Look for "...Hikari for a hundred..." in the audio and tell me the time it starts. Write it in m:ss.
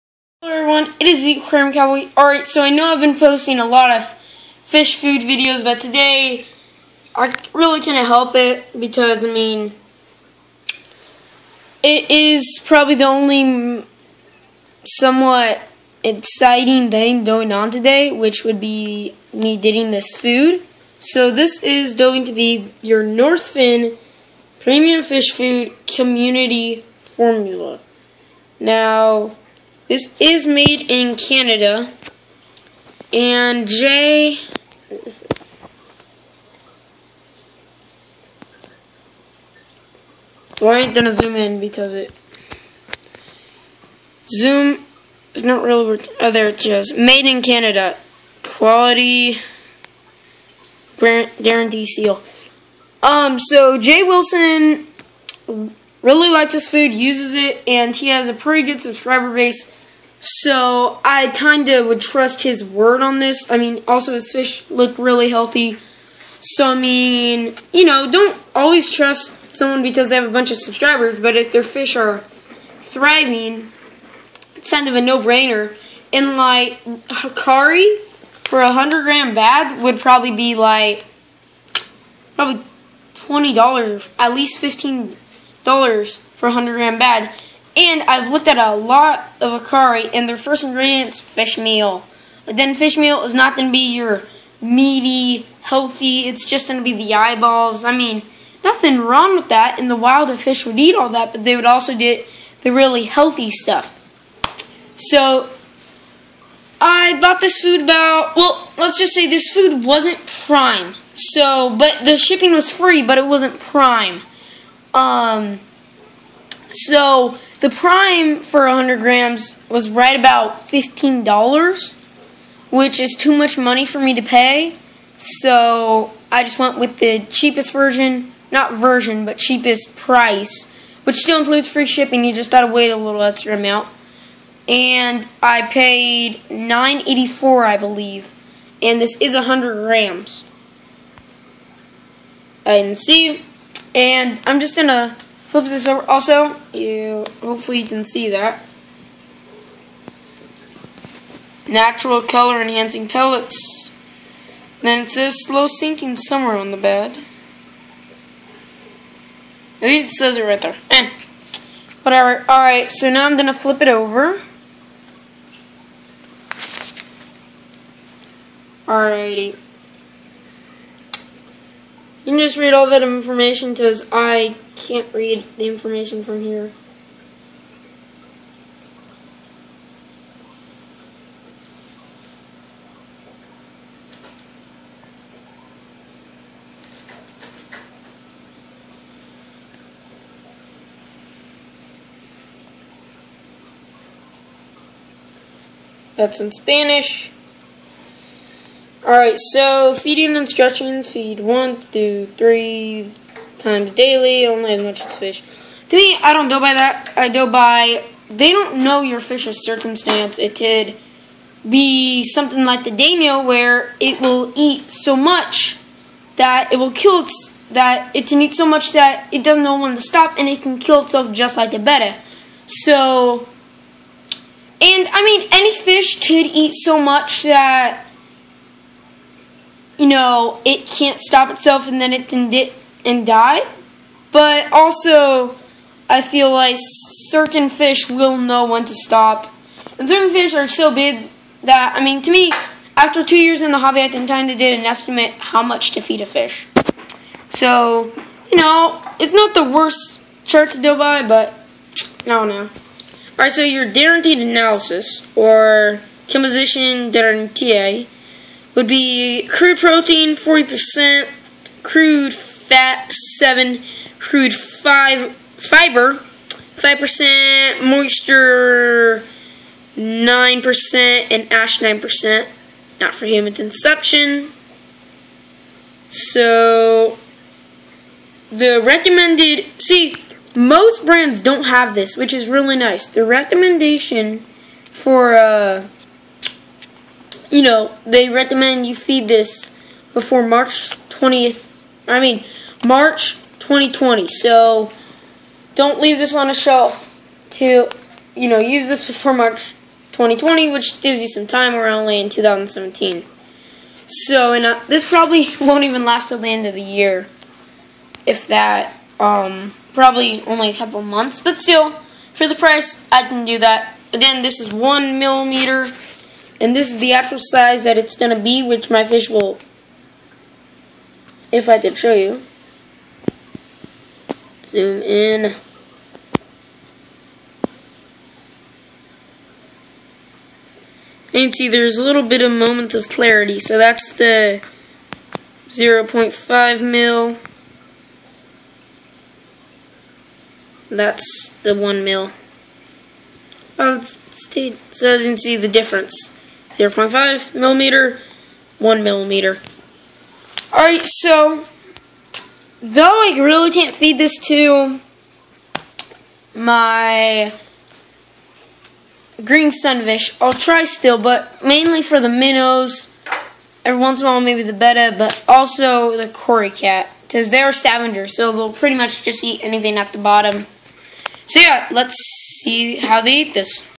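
1:16.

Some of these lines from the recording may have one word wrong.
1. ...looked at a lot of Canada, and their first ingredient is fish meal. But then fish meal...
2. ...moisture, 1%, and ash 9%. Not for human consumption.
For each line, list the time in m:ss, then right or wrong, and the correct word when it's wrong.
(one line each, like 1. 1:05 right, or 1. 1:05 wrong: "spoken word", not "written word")
1. 1:28 wrong: "Hikari", not "Canada"
2. 4:27 wrong: "9", not "1".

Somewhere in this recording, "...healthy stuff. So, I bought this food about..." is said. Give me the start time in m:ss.
1:43.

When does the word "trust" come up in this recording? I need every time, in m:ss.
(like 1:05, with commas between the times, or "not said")
1:01, 1:08.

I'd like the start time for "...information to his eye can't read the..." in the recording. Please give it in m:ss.
2:53.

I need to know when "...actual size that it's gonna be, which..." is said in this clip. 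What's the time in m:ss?
5:17.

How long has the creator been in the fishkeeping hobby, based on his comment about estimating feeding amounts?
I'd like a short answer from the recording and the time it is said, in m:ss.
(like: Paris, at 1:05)
2 years, at 4:03.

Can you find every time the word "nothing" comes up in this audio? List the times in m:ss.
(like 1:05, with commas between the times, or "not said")
1:38.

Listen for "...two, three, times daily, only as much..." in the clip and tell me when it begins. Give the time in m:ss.
3:21.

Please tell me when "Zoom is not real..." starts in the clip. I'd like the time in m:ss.
0:44.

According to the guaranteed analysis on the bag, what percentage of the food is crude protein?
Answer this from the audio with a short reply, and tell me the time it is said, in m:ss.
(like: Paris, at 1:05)
40%, at 4:20.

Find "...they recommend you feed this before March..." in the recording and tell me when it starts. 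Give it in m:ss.
4:48.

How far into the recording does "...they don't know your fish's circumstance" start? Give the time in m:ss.
3:28.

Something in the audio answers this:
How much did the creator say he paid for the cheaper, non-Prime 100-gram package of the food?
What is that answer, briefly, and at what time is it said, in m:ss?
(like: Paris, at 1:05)
$9.84, at 2:16.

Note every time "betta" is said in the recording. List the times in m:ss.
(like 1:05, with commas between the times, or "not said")
3:41, 6:04.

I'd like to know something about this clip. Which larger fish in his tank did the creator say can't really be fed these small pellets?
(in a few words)
green sunfish.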